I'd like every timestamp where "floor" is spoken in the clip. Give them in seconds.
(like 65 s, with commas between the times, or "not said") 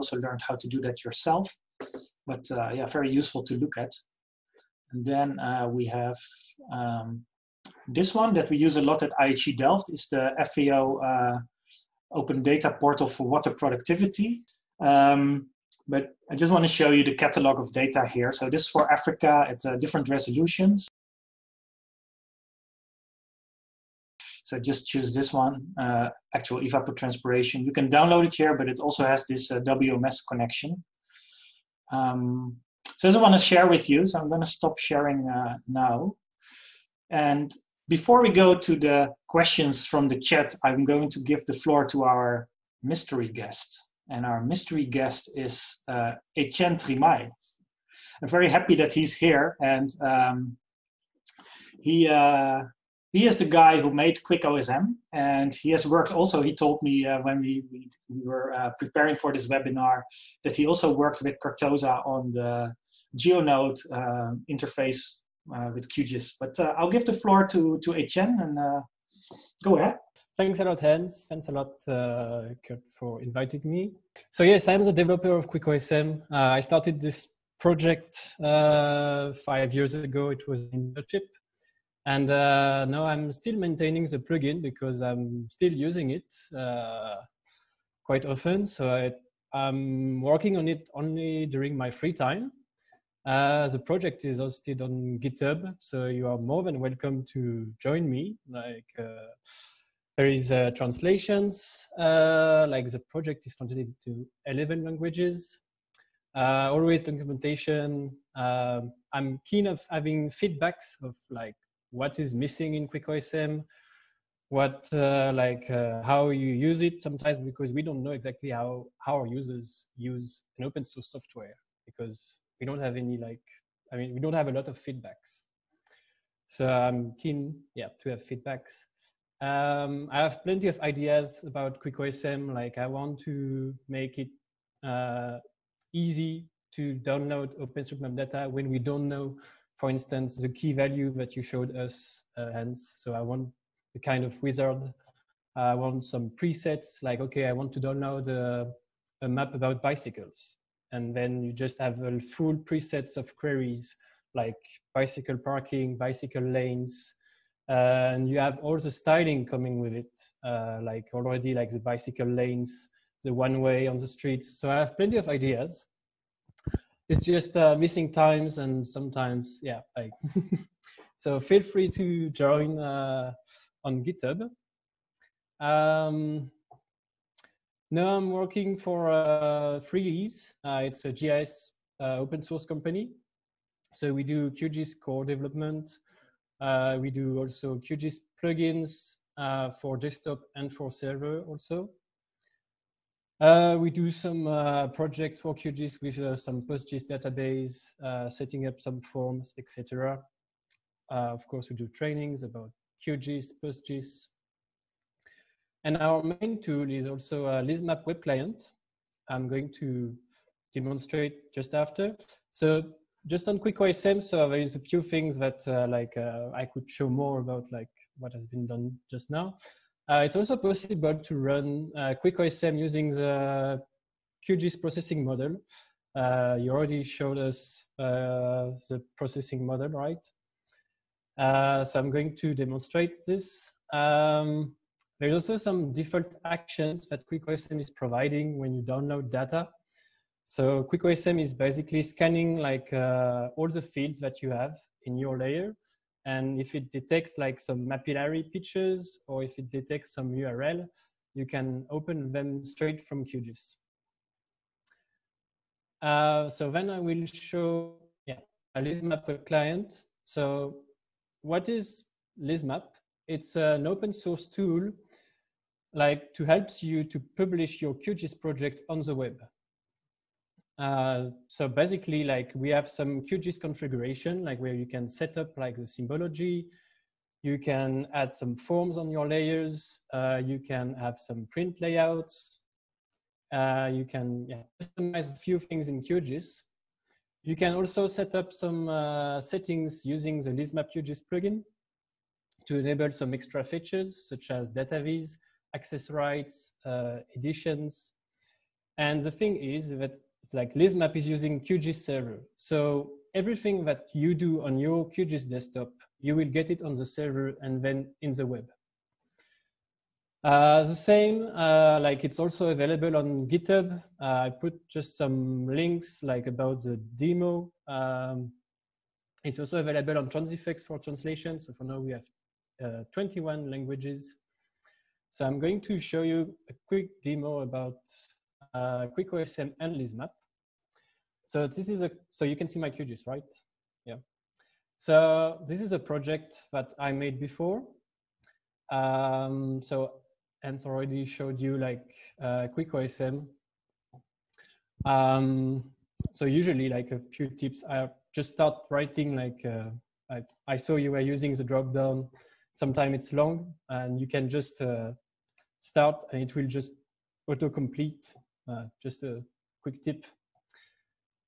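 41 s, 67 s.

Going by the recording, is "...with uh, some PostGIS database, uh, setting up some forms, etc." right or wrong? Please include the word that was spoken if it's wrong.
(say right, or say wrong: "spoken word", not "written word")
right.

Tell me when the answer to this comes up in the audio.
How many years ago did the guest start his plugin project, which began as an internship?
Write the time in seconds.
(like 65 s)
78 s.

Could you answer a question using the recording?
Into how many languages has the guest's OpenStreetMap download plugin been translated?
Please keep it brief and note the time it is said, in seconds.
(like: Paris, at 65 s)
11, at 104 s.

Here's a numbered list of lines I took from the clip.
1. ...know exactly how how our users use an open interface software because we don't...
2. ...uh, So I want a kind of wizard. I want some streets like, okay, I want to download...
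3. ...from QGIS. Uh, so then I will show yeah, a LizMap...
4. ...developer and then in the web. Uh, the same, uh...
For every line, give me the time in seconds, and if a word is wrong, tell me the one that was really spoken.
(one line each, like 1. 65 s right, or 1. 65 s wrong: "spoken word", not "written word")
1. 118 s wrong: "source", not "interface"
2. 142 s wrong: "presets", not "streets"
3. 253 s right
4. 307 s wrong: "server", not "developer".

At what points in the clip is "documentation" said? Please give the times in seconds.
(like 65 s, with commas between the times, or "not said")
107 s.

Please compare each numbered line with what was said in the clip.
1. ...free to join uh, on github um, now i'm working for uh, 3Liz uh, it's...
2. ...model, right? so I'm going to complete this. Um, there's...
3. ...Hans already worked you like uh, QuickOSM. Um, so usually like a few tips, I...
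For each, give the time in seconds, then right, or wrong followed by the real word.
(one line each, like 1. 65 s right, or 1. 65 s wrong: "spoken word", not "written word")
1. 171 s right
2. 229 s wrong: "demonstrate", not "complete"
3. 340 s wrong: "showed", not "worked".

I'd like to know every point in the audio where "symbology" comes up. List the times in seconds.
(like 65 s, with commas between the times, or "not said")
275 s.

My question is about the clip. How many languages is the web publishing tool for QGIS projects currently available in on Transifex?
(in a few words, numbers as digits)
21.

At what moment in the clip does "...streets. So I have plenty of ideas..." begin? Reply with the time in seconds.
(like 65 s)
164 s.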